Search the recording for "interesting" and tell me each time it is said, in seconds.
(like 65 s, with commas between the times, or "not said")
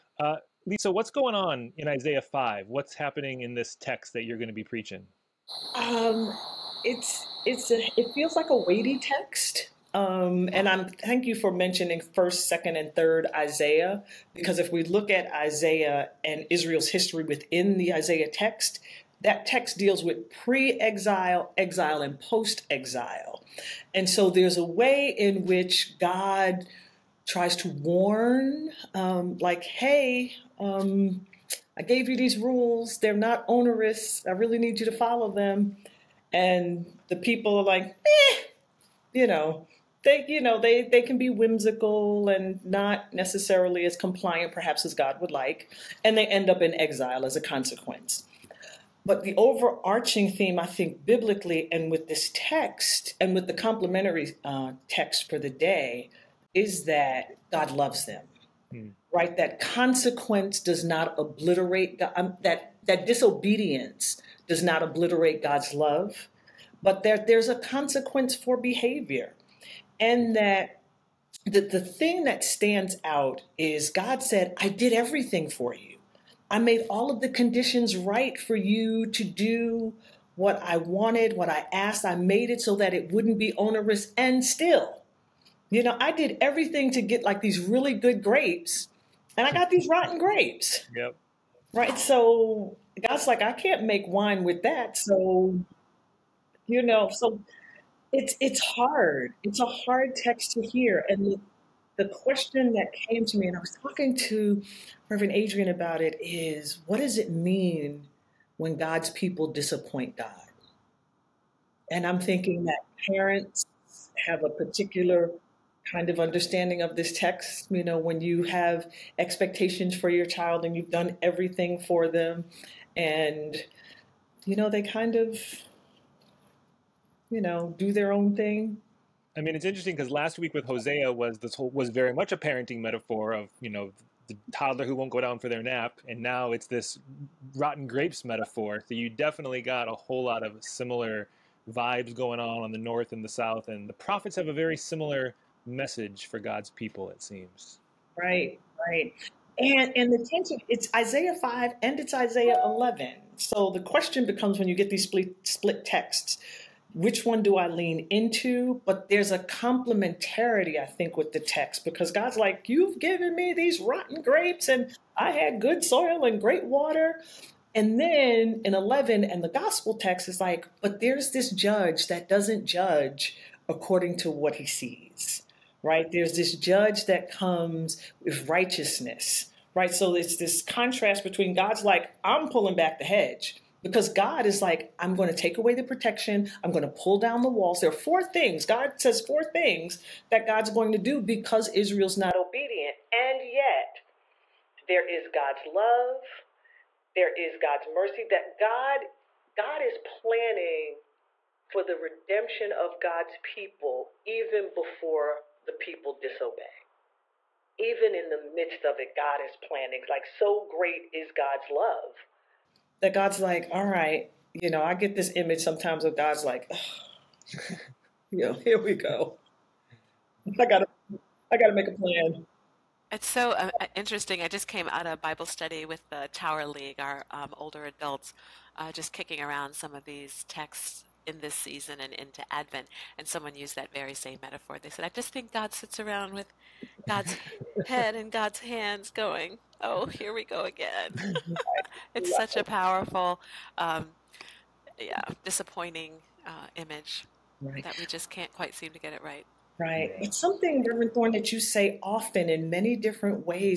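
129 s, 223 s.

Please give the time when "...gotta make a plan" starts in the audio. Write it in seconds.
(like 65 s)
221 s.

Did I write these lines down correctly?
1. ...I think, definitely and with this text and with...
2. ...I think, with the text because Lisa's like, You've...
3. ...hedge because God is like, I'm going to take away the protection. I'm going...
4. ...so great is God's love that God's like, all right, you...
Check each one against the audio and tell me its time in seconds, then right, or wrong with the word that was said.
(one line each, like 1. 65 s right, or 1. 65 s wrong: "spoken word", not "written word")
1. 50 s wrong: "biblically", not "definitely"
2. 160 s wrong: "God", not "Lisa"
3. 183 s right
4. 210 s right.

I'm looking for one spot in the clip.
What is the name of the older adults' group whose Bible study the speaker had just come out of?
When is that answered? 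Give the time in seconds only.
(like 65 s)
226 s.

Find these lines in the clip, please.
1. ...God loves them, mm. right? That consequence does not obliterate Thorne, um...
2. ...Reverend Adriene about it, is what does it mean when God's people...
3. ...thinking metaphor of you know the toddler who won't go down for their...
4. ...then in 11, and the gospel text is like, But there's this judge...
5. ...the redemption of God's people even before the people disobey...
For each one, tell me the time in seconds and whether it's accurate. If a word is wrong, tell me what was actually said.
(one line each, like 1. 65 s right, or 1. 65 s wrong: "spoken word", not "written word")
1. 57 s wrong: "God", not "Thorne"
2. 105 s right
3. 132 s wrong: "parenting", not "thinking"
4. 168 s right
5. 201 s right.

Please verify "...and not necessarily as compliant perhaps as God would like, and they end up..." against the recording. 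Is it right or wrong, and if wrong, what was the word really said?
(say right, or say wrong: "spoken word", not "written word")
right.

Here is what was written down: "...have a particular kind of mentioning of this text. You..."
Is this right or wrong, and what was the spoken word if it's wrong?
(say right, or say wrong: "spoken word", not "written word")
wrong: "understanding", not "mentioning".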